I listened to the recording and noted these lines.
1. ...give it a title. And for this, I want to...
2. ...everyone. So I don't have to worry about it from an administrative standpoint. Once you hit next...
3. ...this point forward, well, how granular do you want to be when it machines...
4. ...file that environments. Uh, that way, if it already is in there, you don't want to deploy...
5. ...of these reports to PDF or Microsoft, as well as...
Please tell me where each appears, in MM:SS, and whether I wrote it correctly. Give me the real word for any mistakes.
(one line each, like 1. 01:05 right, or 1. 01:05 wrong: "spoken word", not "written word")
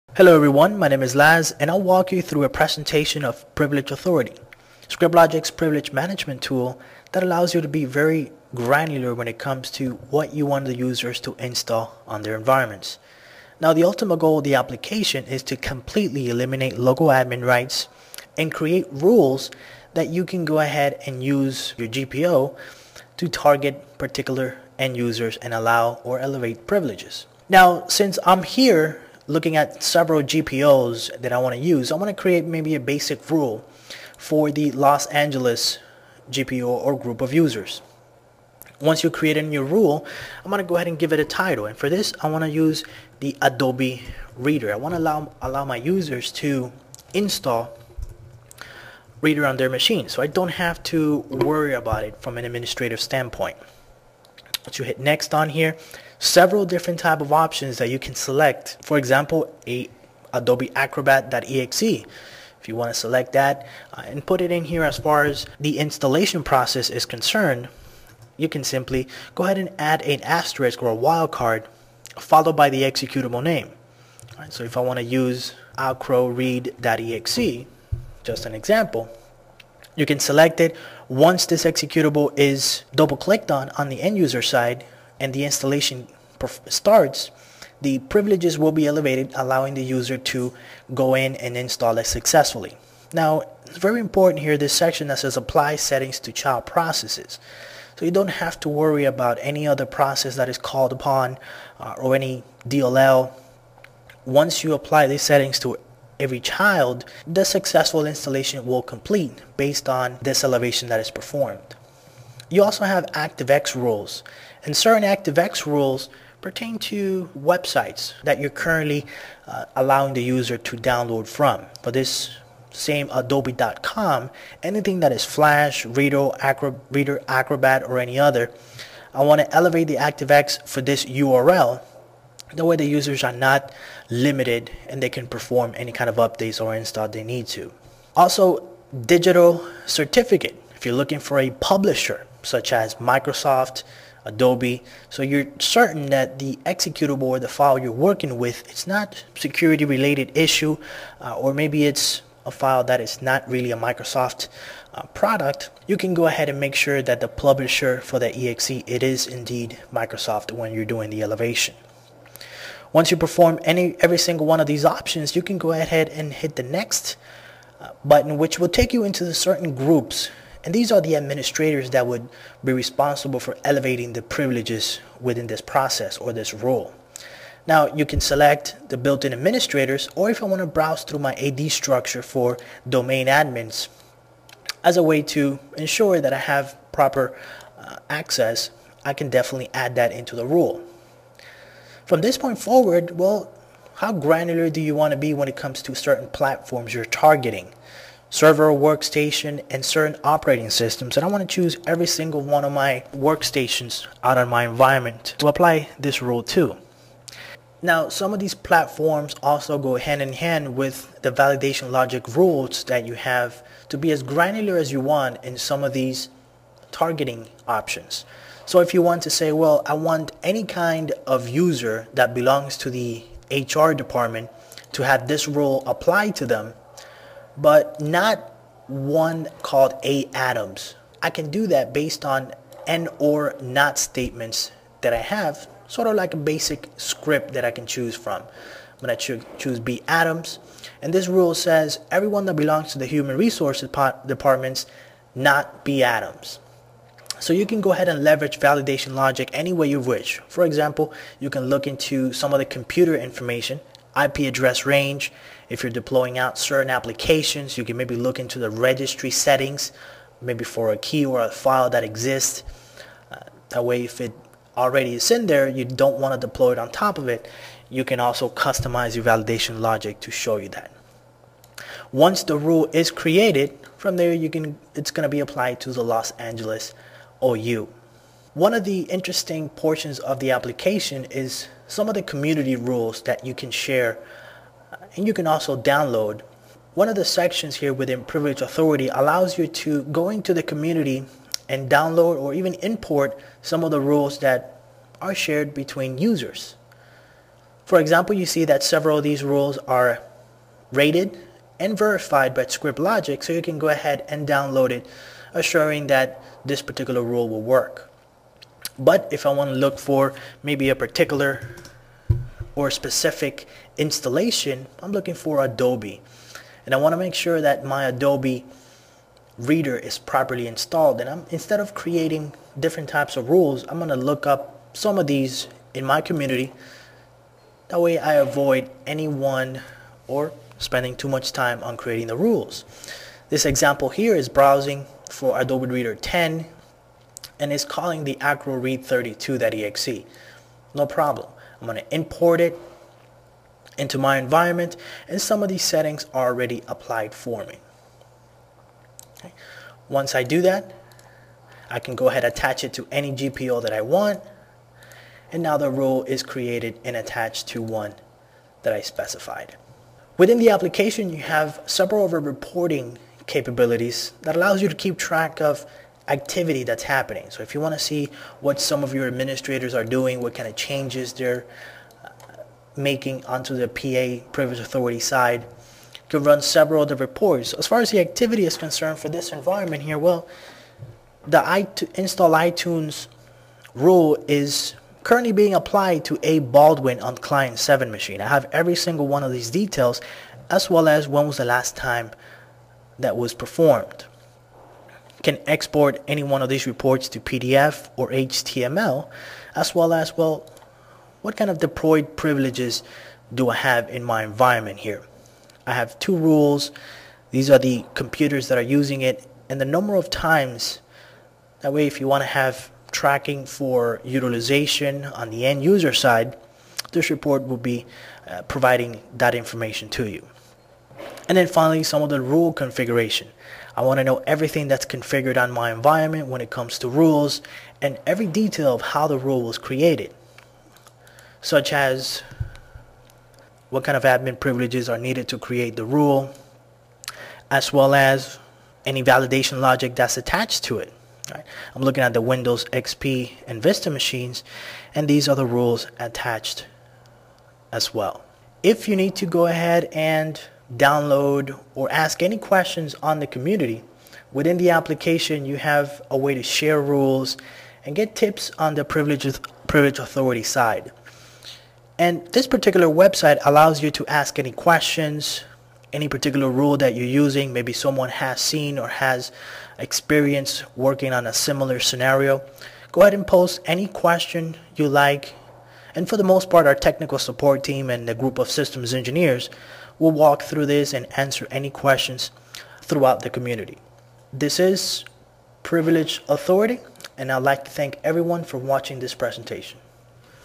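1. 00:40 right
2. 00:49 wrong: "machine", not "everyone"
3. 03:12 wrong: "comes", not "machines"
4. 04:21 wrong: "exists", not "environments"
5. 06:36 wrong: "HTML", not "Microsoft".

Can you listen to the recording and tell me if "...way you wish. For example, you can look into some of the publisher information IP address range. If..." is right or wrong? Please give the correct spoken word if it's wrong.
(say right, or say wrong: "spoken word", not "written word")
wrong: "computer", not "publisher".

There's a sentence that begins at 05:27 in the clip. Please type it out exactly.
That way I avoid anyone or spending too much time on creating the rules.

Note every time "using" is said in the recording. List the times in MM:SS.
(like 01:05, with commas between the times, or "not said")
06:48, 07:47.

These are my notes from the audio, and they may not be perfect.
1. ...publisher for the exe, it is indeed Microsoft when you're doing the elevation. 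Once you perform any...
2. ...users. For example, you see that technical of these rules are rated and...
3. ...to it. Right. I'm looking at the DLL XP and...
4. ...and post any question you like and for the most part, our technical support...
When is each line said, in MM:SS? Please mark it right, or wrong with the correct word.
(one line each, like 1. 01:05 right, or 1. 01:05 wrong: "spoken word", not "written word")
1. 02:37 right
2. 04:56 wrong: "several", not "technical"
3. 07:20 wrong: "Windows", not "DLL"
4. 07:53 right.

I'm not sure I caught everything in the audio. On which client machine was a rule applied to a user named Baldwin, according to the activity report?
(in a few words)
client 7.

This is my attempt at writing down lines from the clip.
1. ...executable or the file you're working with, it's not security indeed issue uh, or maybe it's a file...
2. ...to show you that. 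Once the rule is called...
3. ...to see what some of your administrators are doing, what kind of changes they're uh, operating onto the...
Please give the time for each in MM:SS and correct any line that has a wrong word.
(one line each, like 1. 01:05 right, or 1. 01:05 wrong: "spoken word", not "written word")
1. 02:26 wrong: "related", not "indeed"
2. 04:30 wrong: "created", not "called"
3. 06:07 wrong: "making", not "operating".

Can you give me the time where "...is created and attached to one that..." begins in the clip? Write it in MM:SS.
05:56.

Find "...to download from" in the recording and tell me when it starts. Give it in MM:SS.
02:00.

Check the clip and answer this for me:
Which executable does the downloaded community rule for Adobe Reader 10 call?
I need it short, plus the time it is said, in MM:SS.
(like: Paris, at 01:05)
AcroRead32.exe, at 05:38.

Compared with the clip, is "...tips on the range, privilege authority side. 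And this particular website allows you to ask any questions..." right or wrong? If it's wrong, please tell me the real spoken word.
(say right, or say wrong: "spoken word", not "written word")
wrong: "privilege", not "range".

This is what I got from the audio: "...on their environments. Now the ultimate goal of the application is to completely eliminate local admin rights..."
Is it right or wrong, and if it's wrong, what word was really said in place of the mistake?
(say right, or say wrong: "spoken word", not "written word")
right.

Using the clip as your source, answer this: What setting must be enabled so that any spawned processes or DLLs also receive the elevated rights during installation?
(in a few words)
Apply settings to child processes.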